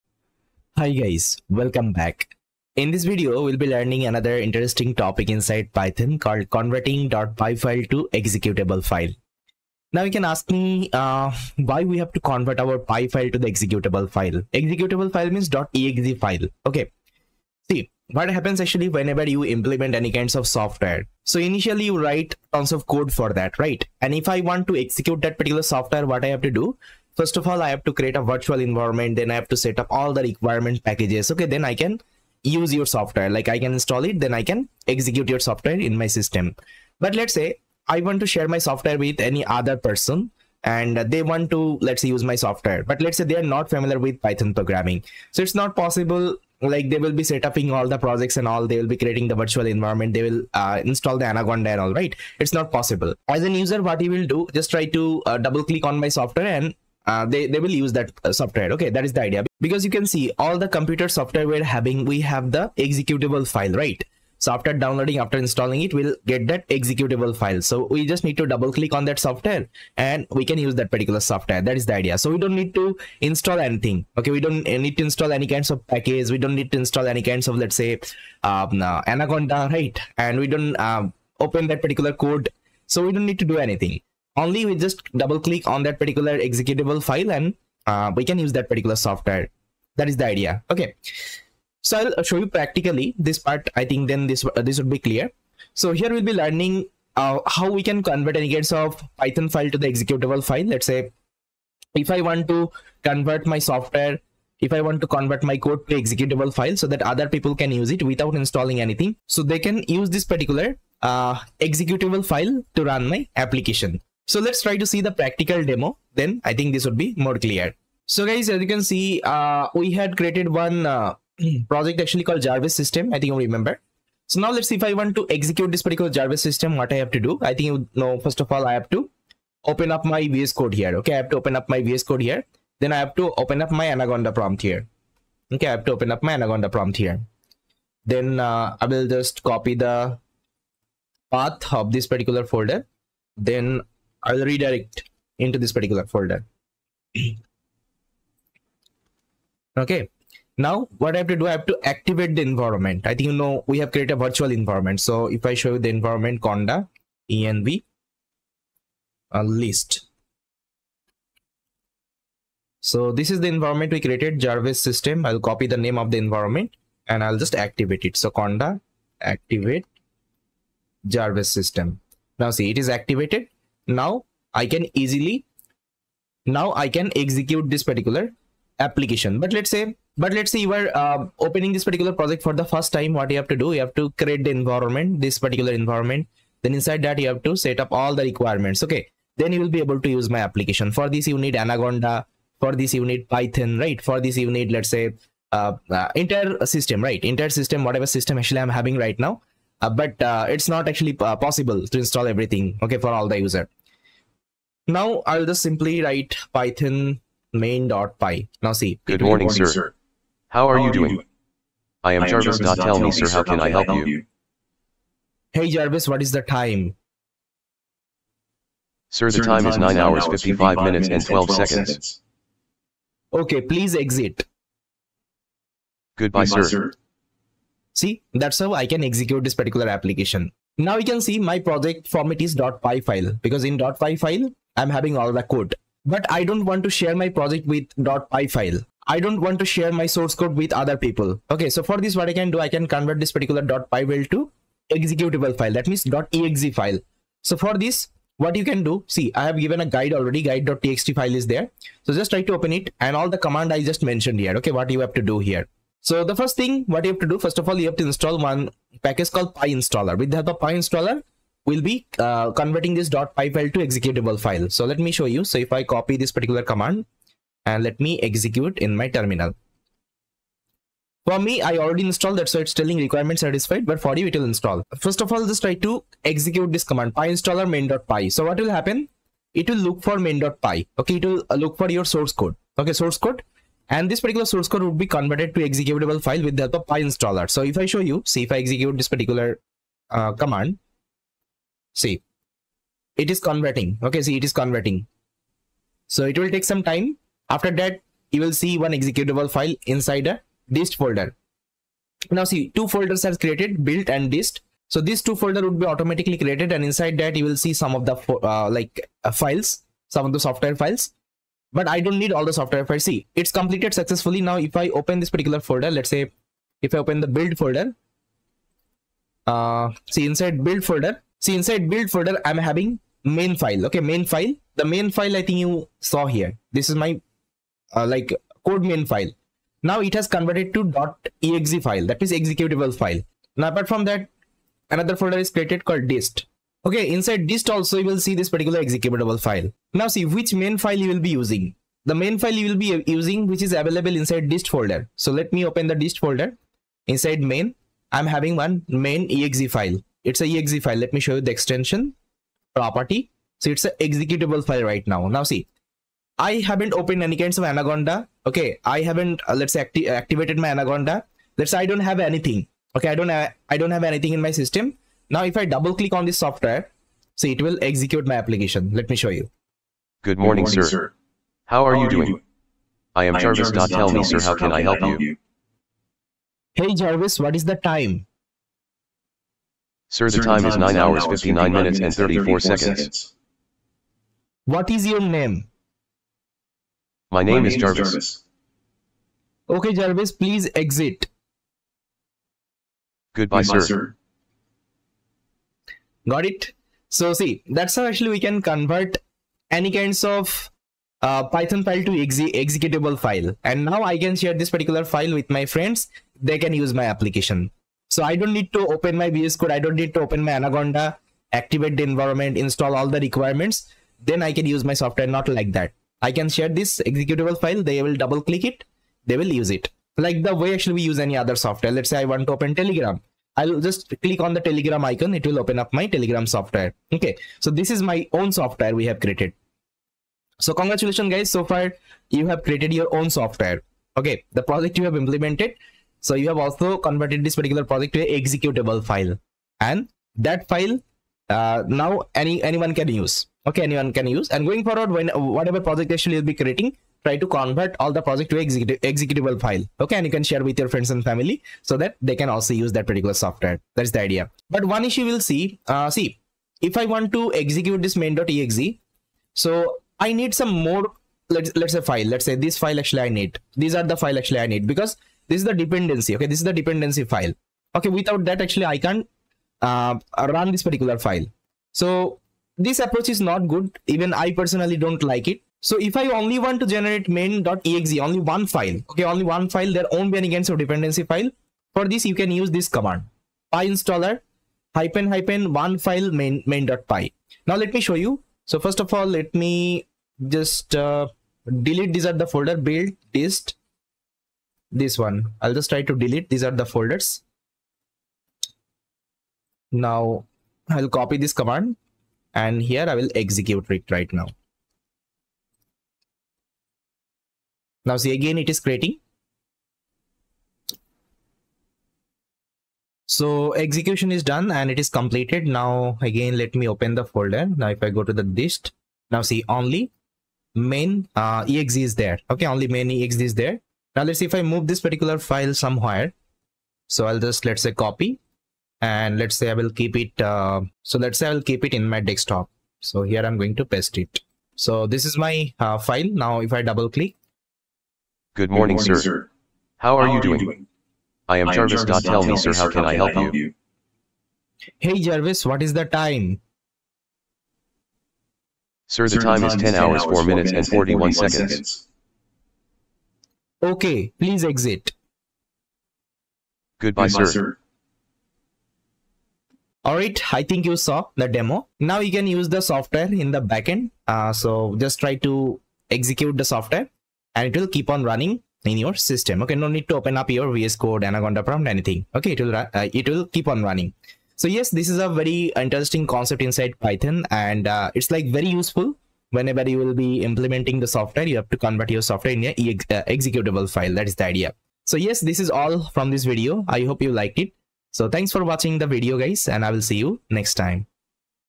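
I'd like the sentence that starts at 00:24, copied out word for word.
And if I want to execute that particular software, what I have to do?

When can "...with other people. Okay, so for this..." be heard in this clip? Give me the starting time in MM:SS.
04:00.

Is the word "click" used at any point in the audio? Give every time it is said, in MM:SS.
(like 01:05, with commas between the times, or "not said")
00:55, 01:08, 01:25, 06:05, 06:58, 07:04, 08:57.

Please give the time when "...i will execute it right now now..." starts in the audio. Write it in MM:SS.
08:23.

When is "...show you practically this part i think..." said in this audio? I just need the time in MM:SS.
01:32.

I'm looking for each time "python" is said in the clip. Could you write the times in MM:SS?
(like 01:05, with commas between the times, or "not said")
00:05, 00:44, 01:39, 03:13, 03:26, 06:41, 09:36.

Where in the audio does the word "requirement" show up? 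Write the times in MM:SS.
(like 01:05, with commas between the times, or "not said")
00:30, 03:08, 04:32, 06:53.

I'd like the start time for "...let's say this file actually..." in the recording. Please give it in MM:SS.
07:42.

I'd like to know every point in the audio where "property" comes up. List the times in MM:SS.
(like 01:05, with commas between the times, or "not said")
05:52.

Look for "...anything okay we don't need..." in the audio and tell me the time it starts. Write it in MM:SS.
01:13.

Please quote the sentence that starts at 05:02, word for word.
Now see, two folders are created, built and dist.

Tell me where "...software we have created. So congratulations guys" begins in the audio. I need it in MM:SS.
07:08.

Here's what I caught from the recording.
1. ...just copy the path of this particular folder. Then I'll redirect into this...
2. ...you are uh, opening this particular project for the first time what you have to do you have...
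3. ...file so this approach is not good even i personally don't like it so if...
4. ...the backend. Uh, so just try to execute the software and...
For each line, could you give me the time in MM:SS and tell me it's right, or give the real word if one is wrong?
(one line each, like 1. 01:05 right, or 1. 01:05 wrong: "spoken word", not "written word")
1. 02:19 right
2. 03:00 right
3. 07:51 right
4. 09:23 right.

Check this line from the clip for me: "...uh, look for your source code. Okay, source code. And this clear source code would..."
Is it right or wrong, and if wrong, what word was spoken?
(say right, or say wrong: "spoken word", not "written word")
wrong: "particular", not "clear".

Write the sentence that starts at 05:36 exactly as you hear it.
Okay, inside dist also you will see this particular executable file.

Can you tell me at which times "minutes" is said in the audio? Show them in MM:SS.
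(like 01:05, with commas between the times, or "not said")
03:40, 06:21, 09:10.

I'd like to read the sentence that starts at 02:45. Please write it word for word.
I'll copy the name of the environment and I'll just activate it.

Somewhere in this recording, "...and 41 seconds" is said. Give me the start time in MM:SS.
09:10.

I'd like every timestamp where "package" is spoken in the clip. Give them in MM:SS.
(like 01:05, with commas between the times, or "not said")
00:30, 01:15, 04:19.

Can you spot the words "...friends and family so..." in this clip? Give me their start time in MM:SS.
07:30.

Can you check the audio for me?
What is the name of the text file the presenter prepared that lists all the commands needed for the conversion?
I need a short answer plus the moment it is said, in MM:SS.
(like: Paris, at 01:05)
guide.txt, at 04:10.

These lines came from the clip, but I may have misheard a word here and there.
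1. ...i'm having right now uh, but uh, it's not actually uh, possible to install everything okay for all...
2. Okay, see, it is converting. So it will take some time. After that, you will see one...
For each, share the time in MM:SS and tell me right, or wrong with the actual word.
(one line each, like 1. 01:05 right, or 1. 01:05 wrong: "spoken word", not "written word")
1. 03:18 right
2. 04:54 right.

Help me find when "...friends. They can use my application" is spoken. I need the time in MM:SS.
06:45.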